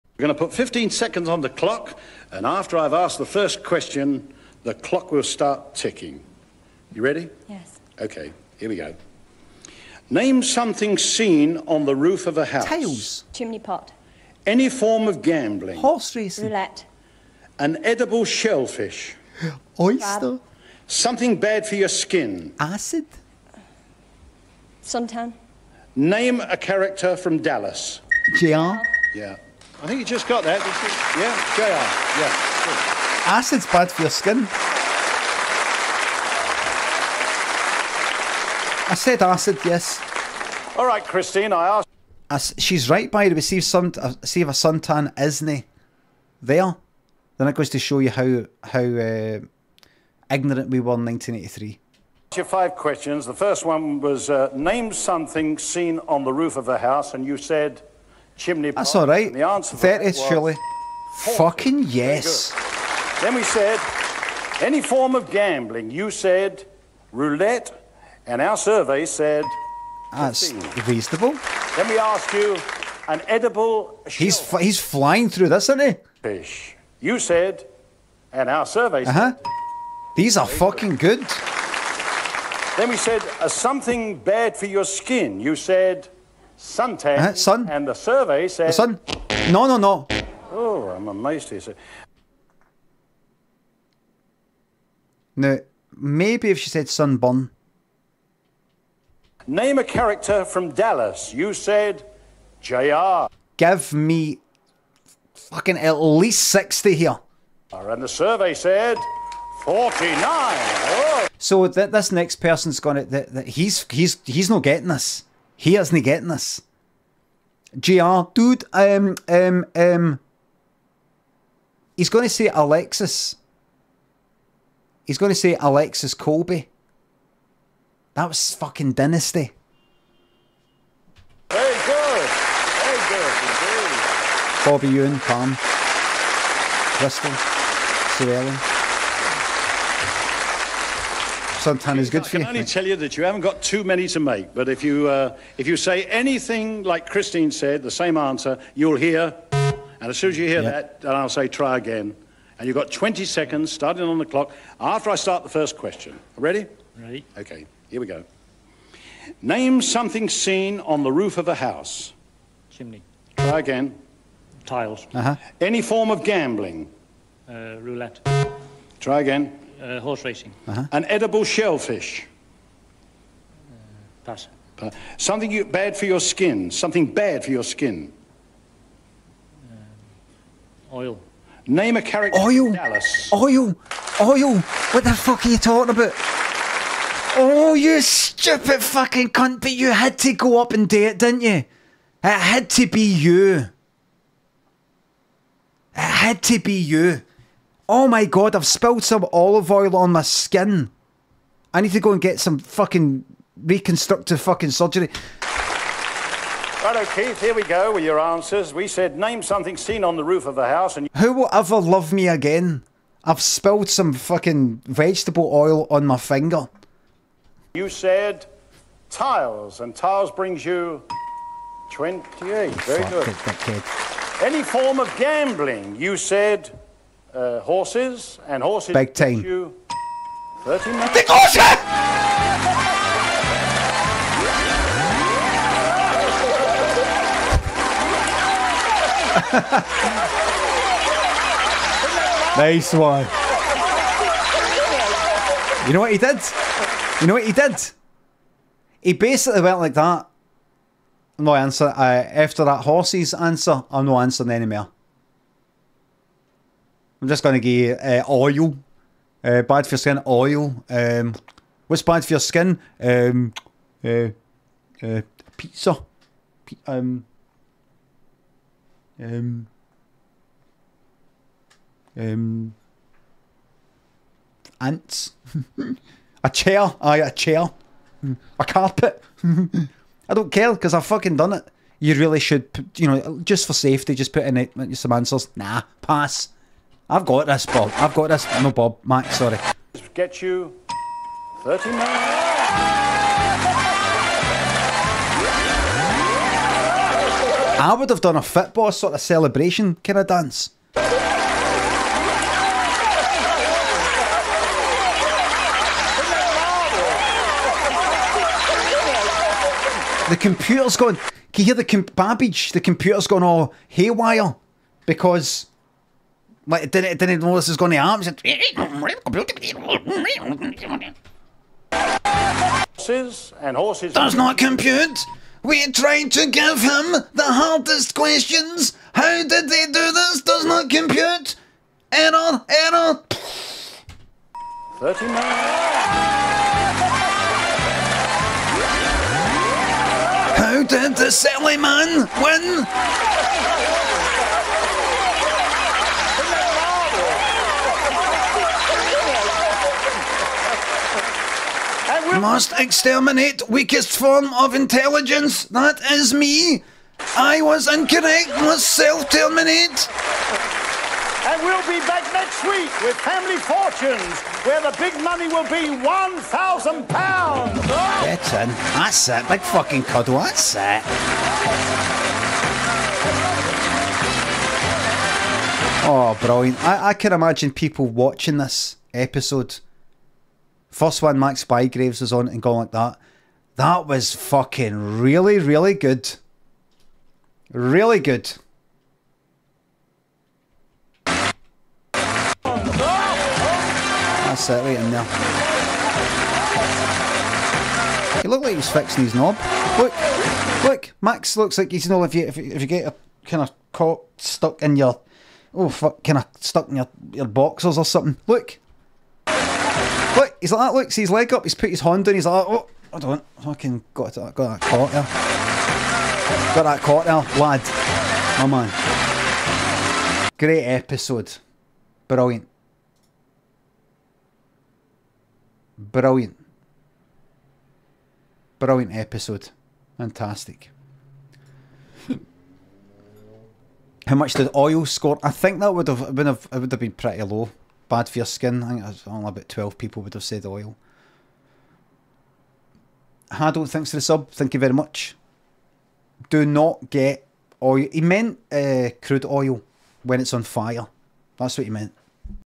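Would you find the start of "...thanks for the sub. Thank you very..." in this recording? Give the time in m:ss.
7:23.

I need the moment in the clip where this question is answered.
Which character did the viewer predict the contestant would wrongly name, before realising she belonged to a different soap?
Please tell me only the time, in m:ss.
2:05.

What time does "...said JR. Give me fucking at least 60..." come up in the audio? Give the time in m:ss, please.
1:41.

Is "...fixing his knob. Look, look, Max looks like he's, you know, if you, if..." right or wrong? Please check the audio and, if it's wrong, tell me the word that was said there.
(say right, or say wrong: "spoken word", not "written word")
right.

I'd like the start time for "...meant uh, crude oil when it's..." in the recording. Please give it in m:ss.
7:28.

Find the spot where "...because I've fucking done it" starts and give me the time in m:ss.
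4:40.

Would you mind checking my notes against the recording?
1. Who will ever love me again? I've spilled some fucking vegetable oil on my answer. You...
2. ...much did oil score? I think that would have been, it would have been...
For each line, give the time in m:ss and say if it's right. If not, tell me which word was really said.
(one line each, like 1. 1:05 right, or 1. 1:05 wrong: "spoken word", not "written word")
1. 3:31 wrong: "finger", not "answer"
2. 7:14 right.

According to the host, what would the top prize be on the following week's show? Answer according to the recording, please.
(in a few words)
£1,000.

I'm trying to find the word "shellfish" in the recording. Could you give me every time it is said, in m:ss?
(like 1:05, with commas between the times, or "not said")
0:18, 2:51.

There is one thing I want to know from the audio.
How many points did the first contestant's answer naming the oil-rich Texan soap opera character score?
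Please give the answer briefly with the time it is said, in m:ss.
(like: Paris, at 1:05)
49, at 1:49.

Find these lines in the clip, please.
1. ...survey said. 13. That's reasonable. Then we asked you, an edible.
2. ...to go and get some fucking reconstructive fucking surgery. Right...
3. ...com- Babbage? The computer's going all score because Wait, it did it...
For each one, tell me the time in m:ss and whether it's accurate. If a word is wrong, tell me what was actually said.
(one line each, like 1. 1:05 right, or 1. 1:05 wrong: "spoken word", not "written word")
1. 1:08 wrong: "15", not "13"
2. 3:21 right
3. 5:11 wrong: "haywire", not "score".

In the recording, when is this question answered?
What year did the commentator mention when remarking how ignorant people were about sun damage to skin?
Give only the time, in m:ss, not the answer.
0:51.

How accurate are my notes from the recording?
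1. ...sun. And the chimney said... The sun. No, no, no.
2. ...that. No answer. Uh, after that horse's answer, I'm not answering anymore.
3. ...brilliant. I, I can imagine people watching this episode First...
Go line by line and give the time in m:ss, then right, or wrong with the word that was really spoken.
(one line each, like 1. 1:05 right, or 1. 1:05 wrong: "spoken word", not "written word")
1. 1:27 wrong: "survey", not "chimney"
2. 4:09 right
3. 6:16 right.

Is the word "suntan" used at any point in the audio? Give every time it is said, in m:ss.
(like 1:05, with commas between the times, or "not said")
0:24, 0:44.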